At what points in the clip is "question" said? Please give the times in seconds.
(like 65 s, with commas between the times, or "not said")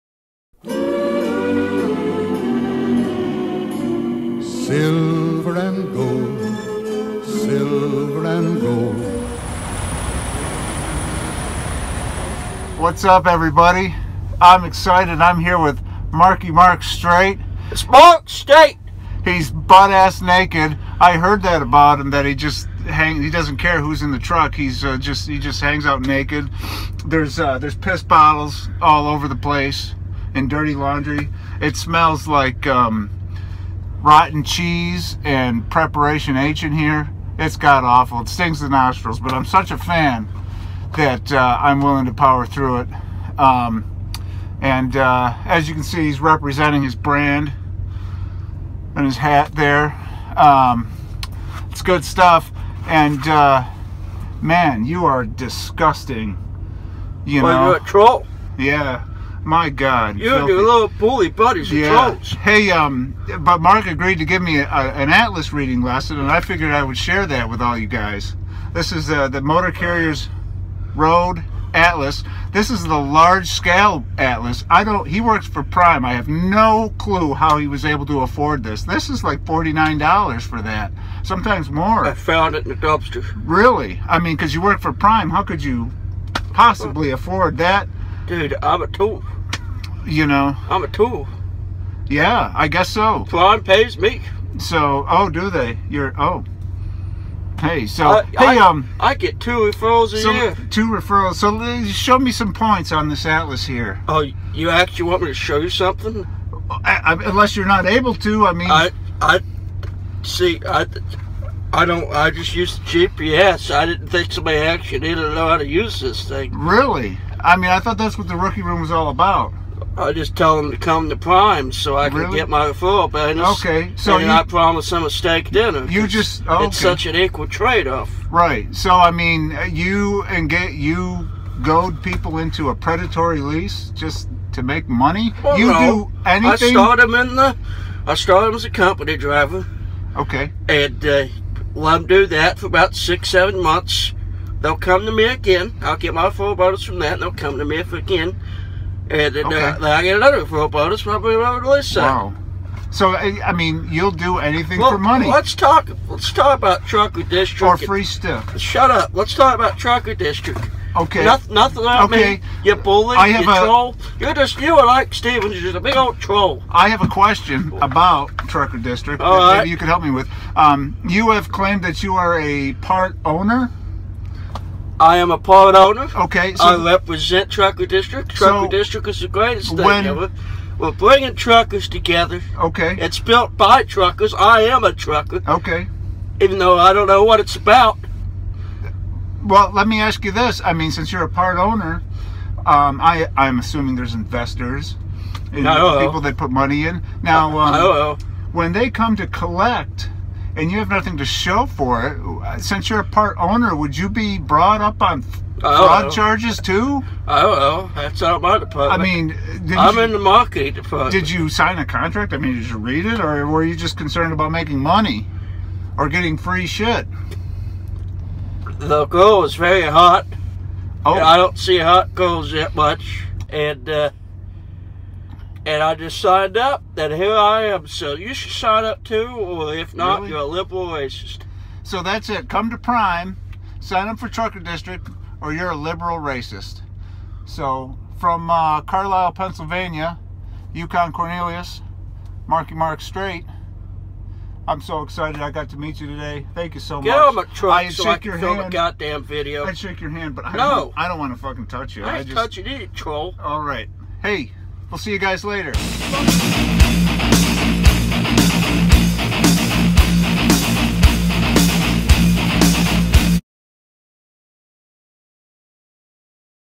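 167 s.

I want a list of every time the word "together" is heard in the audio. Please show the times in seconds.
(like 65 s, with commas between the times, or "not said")
181 s.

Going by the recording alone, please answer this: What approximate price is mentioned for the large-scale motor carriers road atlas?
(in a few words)
$49.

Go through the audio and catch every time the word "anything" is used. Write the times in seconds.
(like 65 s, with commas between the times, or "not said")
136 s, 154 s.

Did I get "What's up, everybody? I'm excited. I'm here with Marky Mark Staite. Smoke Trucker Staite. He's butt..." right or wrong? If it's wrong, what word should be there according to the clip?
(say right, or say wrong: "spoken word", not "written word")
wrong: "Mark", not "Trucker".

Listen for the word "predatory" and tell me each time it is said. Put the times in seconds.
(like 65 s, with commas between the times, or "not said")
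132 s.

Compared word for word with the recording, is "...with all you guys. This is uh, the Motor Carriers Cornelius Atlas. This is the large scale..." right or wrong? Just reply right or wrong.
wrong.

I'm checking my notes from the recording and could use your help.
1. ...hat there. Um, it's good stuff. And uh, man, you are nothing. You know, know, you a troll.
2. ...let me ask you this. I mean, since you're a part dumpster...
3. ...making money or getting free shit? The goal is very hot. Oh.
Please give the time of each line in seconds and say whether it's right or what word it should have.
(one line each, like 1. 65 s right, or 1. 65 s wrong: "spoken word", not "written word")
1. 49 s wrong: "disgusting", not "nothing"
2. 189 s wrong: "owner", not "dumpster"
3. 214 s right.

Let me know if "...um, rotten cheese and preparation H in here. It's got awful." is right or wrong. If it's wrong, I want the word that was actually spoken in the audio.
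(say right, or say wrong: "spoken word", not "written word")
right.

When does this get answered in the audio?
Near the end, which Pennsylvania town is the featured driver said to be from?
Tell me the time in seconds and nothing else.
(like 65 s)
238 s.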